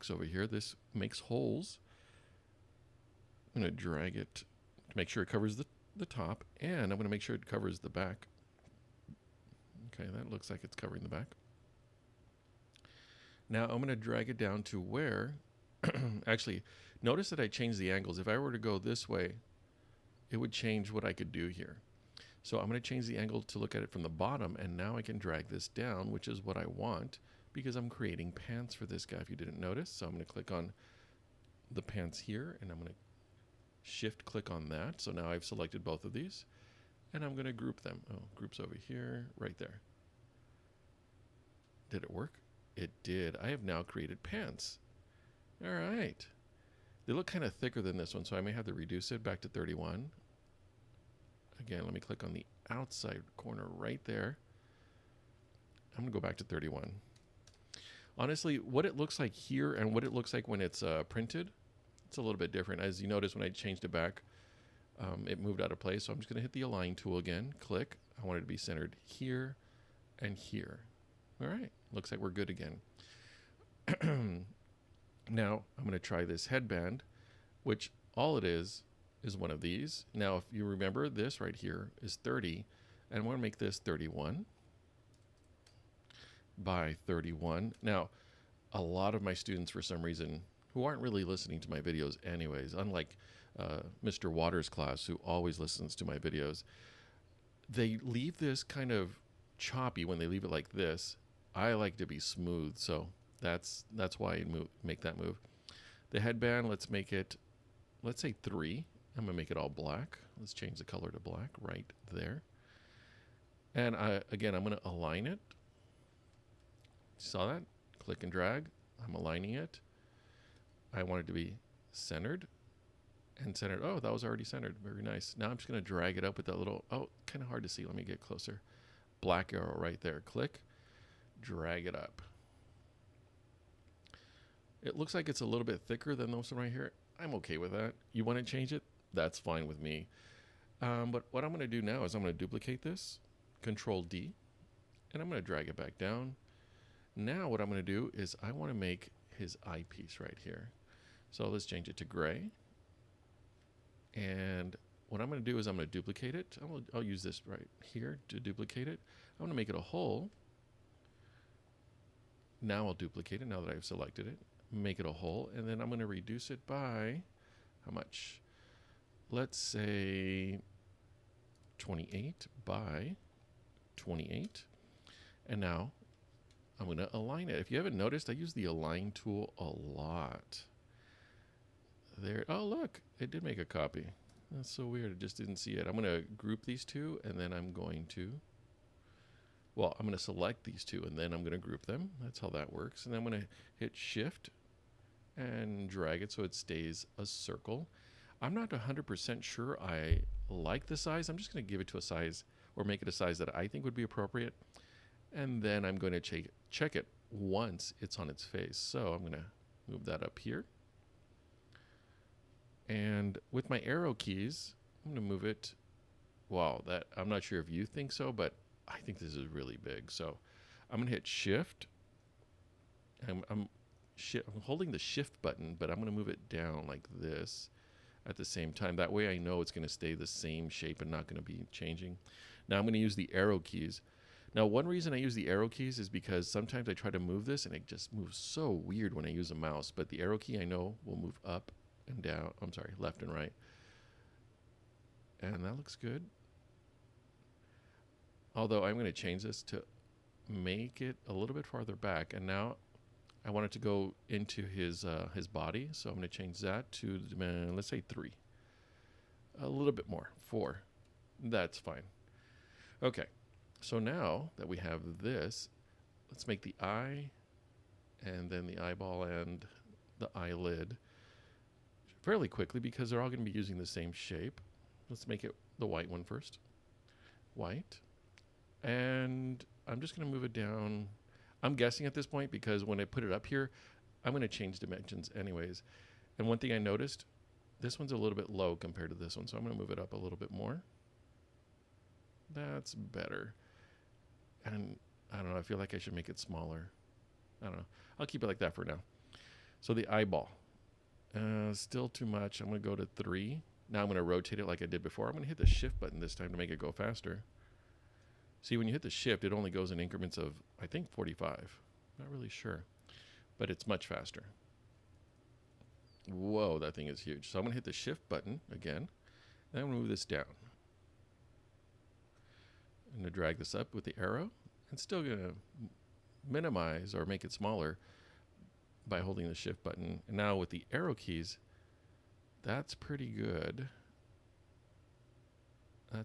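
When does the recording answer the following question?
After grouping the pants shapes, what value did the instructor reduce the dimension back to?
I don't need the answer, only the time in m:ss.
0:55.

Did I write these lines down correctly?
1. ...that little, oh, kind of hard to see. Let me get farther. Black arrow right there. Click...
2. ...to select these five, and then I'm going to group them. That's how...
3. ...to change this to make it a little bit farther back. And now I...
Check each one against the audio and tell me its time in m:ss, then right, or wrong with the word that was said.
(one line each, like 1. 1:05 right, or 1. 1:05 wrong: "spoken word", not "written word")
1. 2:06 wrong: "closer", not "farther"
2. 3:10 wrong: "two", not "five"
3. 4:09 right.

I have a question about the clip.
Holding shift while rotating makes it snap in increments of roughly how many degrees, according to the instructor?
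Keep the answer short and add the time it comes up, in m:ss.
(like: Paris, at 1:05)
45, at 5:11.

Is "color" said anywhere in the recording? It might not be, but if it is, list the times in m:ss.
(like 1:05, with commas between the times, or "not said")
1:50.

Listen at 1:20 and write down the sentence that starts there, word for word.
Now, if you remember, this right here is 30, and I want to make this 31 by 31.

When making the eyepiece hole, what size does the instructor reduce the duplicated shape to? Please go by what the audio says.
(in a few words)
28 by 28.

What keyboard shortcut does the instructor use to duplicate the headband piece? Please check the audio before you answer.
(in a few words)
Control D.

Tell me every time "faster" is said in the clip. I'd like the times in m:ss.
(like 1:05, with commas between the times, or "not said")
5:06, 5:14.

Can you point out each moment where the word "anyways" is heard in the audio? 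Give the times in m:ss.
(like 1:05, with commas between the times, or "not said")
1:32, 4:45.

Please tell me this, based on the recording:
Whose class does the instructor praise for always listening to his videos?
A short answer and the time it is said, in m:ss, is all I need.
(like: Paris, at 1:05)
Mr. Waters' class, at 1:34.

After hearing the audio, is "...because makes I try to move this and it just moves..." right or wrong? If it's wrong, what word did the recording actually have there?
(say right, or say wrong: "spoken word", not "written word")
wrong: "sometimes", not "makes".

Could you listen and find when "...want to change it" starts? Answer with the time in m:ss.
2:18.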